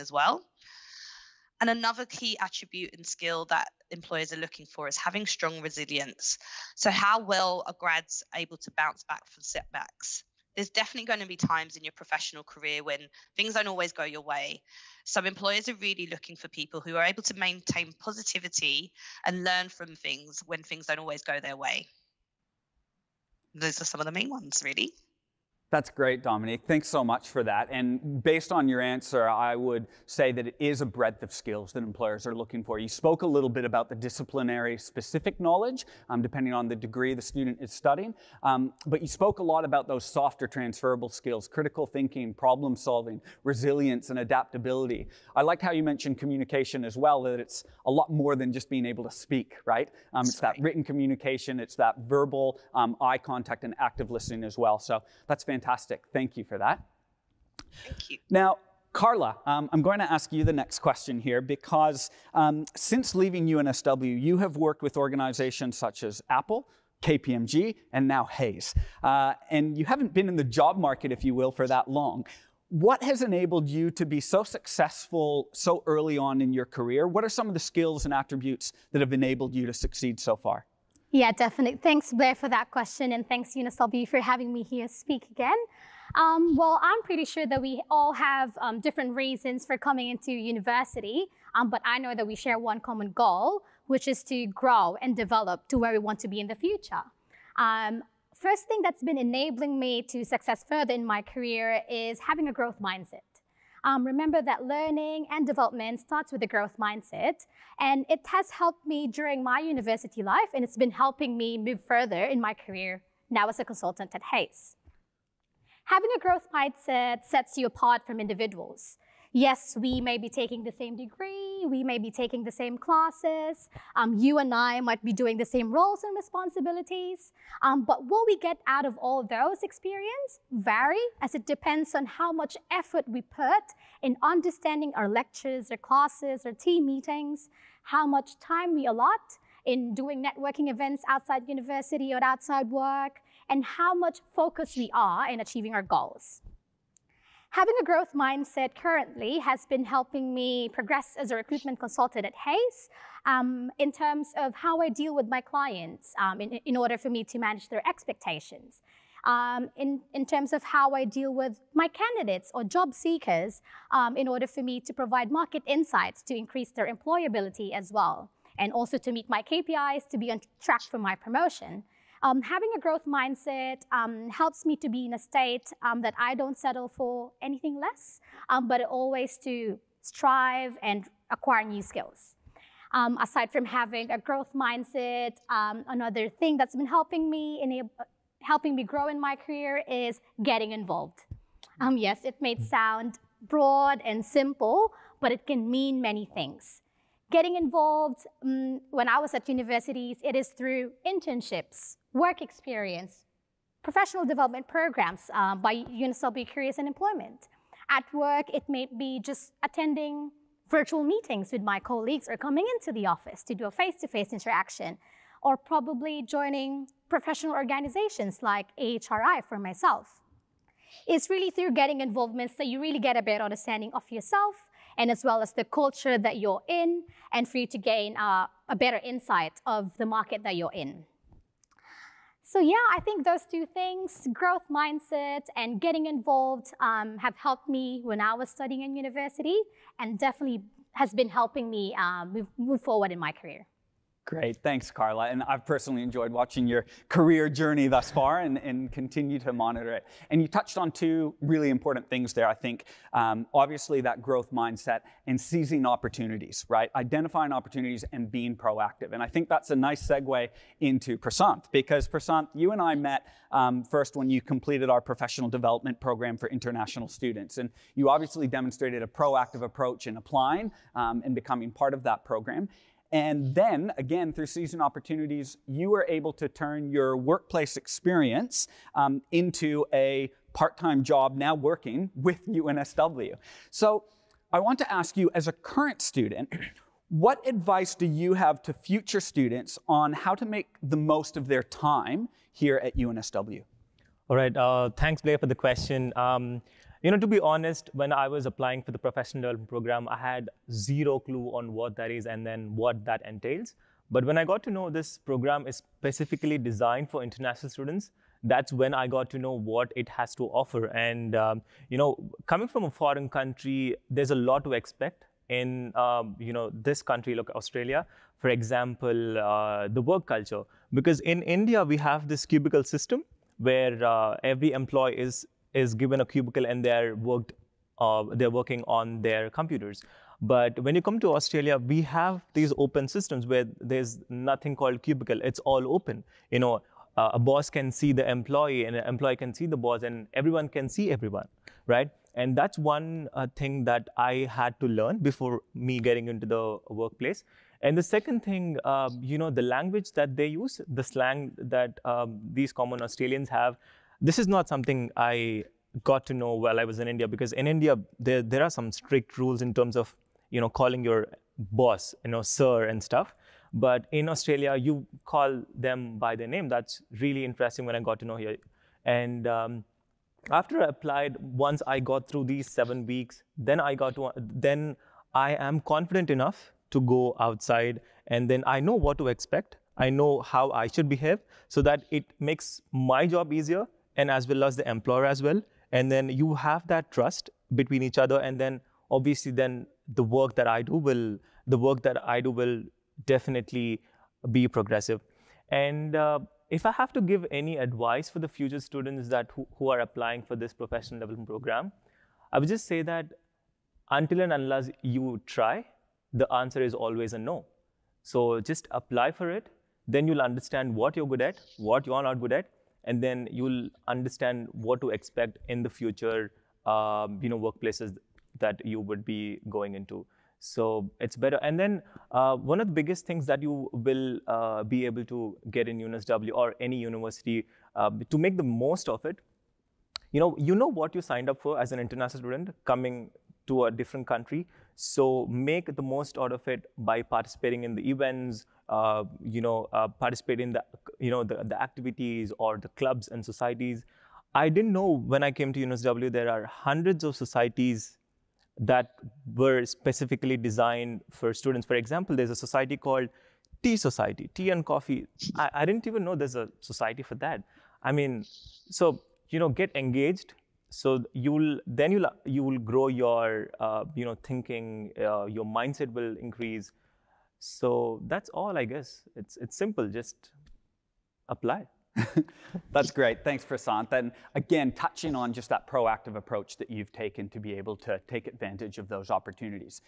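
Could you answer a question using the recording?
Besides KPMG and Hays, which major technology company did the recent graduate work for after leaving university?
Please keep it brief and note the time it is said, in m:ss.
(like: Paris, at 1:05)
Apple, at 1:06.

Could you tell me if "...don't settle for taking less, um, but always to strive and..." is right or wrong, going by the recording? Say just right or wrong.
wrong.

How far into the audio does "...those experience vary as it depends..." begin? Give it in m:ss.
2:09.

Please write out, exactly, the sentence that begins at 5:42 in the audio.
And that's one uh, thing that I had to learn before me getting into the workplace.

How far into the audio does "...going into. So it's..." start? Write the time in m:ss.
6:59.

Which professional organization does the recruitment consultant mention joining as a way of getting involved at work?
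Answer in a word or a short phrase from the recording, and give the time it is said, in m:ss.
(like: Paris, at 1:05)
AHRI, at 3:38.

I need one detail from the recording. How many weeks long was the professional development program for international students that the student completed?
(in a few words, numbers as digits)
7.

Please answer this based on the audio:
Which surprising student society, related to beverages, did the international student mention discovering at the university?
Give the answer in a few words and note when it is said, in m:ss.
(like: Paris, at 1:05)
Tea Society, at 7:33.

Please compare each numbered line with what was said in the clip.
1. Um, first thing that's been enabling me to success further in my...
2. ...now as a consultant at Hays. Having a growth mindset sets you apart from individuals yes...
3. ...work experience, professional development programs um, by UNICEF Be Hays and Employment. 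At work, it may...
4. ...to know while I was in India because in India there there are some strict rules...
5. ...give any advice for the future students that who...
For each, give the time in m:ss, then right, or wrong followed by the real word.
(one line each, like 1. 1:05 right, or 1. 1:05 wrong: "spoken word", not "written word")
1. 1:37 right
2. 1:53 right
3. 3:22 wrong: "Curious", not "Hays"
4. 5:56 right
5. 6:37 right.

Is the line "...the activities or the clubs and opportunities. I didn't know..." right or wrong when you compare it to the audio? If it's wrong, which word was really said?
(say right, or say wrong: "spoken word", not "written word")
wrong: "societies", not "opportunities".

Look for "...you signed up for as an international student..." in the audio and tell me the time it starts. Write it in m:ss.
7:11.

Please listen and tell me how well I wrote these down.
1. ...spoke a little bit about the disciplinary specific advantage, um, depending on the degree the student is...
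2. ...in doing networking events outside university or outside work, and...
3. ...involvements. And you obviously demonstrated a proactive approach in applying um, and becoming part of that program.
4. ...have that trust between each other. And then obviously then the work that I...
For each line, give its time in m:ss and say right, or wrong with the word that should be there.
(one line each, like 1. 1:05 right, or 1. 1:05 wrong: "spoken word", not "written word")
1. 0:32 wrong: "knowledge", not "advantage"
2. 2:19 right
3. 4:27 wrong: "students", not "involvements"
4. 6:26 right.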